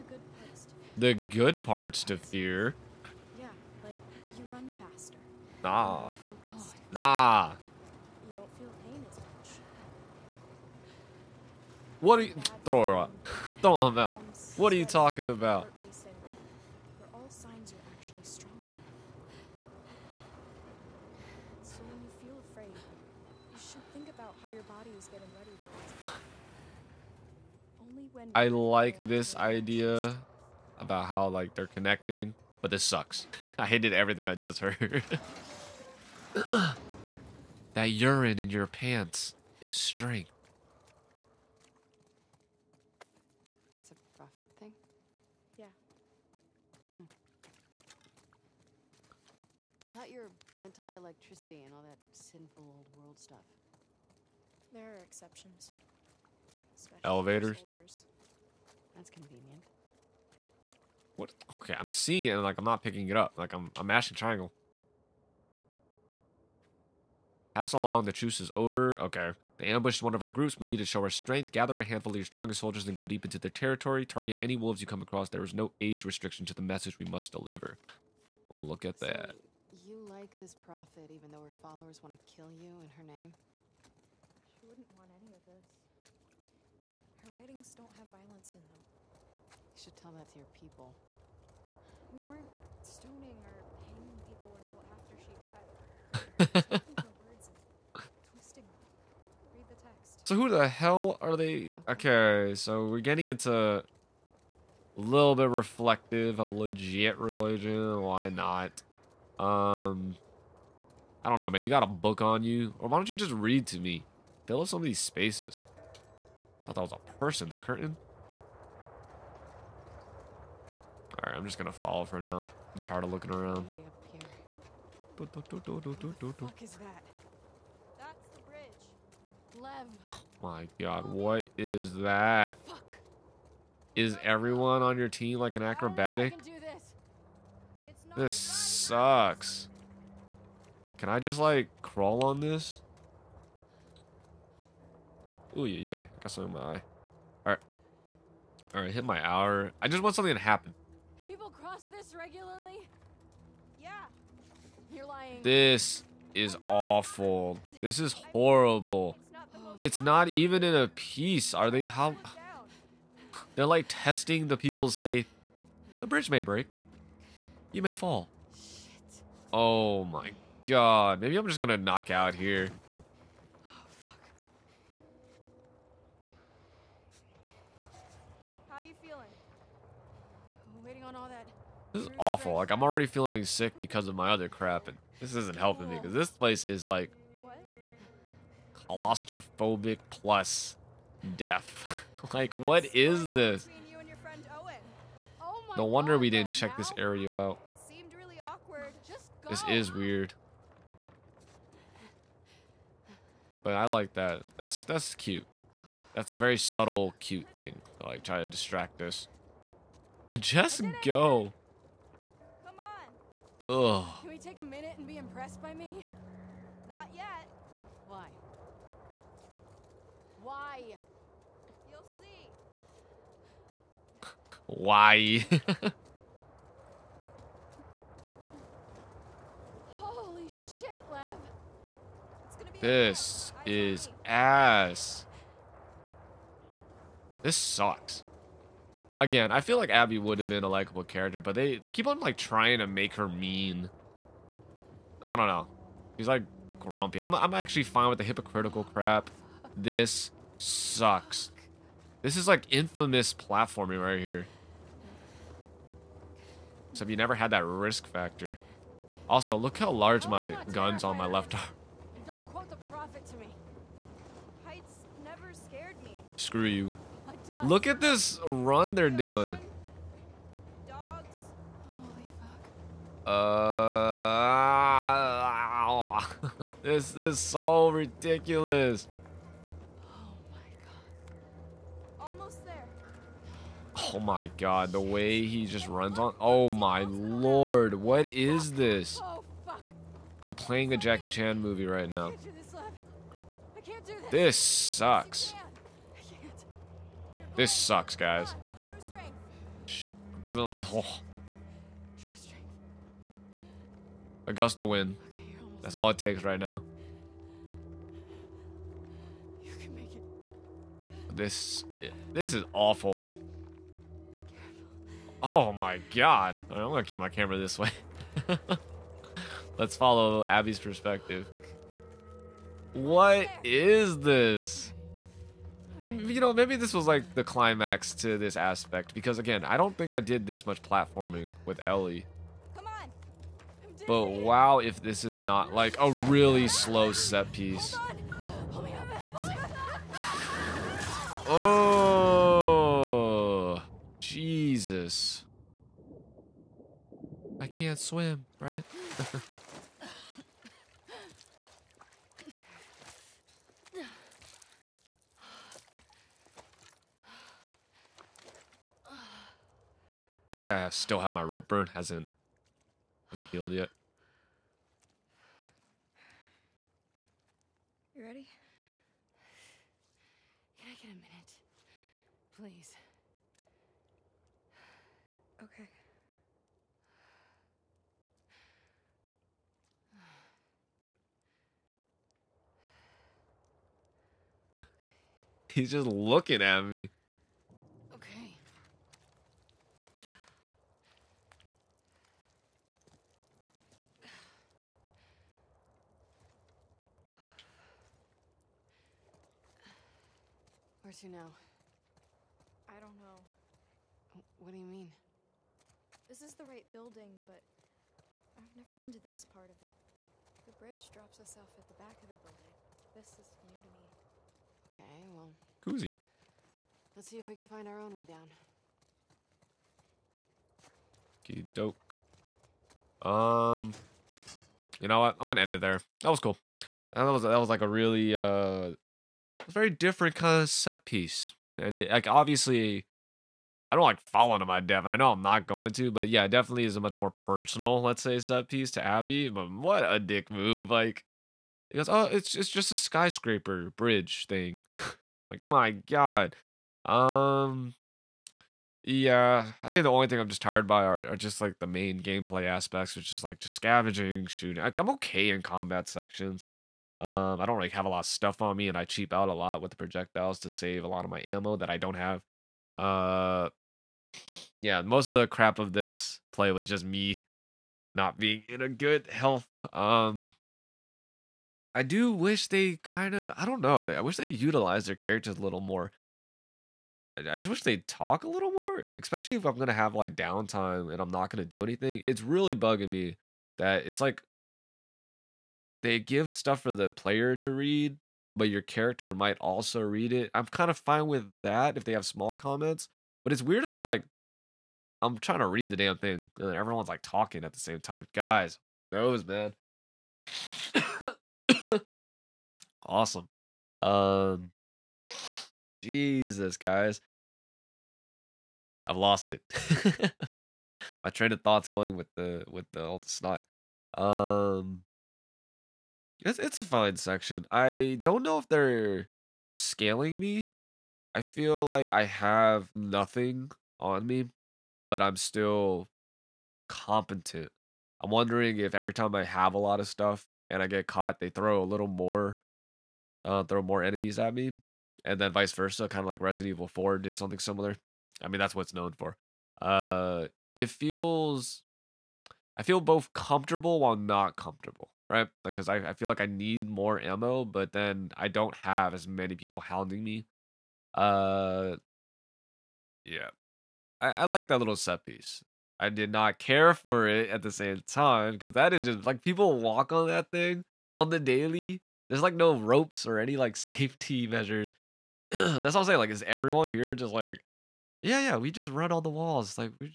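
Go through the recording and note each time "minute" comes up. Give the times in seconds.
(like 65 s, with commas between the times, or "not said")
214 s, 371 s.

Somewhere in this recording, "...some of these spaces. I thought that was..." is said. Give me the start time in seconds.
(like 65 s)
114 s.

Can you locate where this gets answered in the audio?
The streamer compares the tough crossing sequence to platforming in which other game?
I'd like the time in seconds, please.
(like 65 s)
252 s.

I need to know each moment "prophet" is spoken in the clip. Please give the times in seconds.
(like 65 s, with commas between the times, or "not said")
44 s, 80 s.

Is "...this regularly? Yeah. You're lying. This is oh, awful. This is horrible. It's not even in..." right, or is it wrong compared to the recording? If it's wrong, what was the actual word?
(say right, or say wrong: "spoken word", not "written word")
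right.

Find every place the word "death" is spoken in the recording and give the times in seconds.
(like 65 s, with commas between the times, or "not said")
191 s, 434 s.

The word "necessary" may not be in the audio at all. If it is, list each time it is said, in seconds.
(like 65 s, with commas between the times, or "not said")
not said.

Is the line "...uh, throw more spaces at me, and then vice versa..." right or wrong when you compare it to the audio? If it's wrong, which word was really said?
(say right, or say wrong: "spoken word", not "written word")
wrong: "enemies", not "spaces".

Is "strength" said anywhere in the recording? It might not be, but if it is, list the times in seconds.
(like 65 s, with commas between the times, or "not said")
39 s, 71 s.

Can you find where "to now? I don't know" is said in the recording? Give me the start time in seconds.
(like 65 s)
401 s.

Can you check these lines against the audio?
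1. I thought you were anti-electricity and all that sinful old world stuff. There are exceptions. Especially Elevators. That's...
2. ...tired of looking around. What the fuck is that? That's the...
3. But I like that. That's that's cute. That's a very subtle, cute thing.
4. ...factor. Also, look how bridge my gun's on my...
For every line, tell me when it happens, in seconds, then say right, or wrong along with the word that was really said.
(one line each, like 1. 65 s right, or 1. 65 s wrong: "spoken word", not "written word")
1. 49 s right
2. 122 s right
3. 203 s right
4. 258 s wrong: "large", not "bridge".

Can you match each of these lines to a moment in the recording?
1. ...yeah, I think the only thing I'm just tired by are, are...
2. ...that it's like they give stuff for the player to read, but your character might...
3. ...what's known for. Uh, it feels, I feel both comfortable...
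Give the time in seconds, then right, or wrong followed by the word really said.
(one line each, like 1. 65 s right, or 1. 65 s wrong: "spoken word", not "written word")
1. 449 s right
2. 483 s right
3. 538 s right.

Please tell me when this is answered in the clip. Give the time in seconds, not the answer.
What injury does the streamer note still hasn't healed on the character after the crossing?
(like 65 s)
361 s.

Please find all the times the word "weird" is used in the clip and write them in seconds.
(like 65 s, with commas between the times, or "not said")
199 s, 493 s.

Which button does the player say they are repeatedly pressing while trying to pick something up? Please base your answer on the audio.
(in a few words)
Triangle.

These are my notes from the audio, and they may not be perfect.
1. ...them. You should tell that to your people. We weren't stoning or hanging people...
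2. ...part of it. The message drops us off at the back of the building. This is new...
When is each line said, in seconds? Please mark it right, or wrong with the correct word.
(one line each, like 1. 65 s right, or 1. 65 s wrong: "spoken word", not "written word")
1. 88 s right
2. 409 s wrong: "bridge", not "message".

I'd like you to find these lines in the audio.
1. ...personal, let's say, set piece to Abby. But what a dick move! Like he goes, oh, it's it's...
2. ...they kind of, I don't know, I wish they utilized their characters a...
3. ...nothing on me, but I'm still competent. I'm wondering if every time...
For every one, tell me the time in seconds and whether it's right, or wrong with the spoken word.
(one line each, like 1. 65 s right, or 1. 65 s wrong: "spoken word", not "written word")
1. 437 s right
2. 472 s right
3. 522 s right.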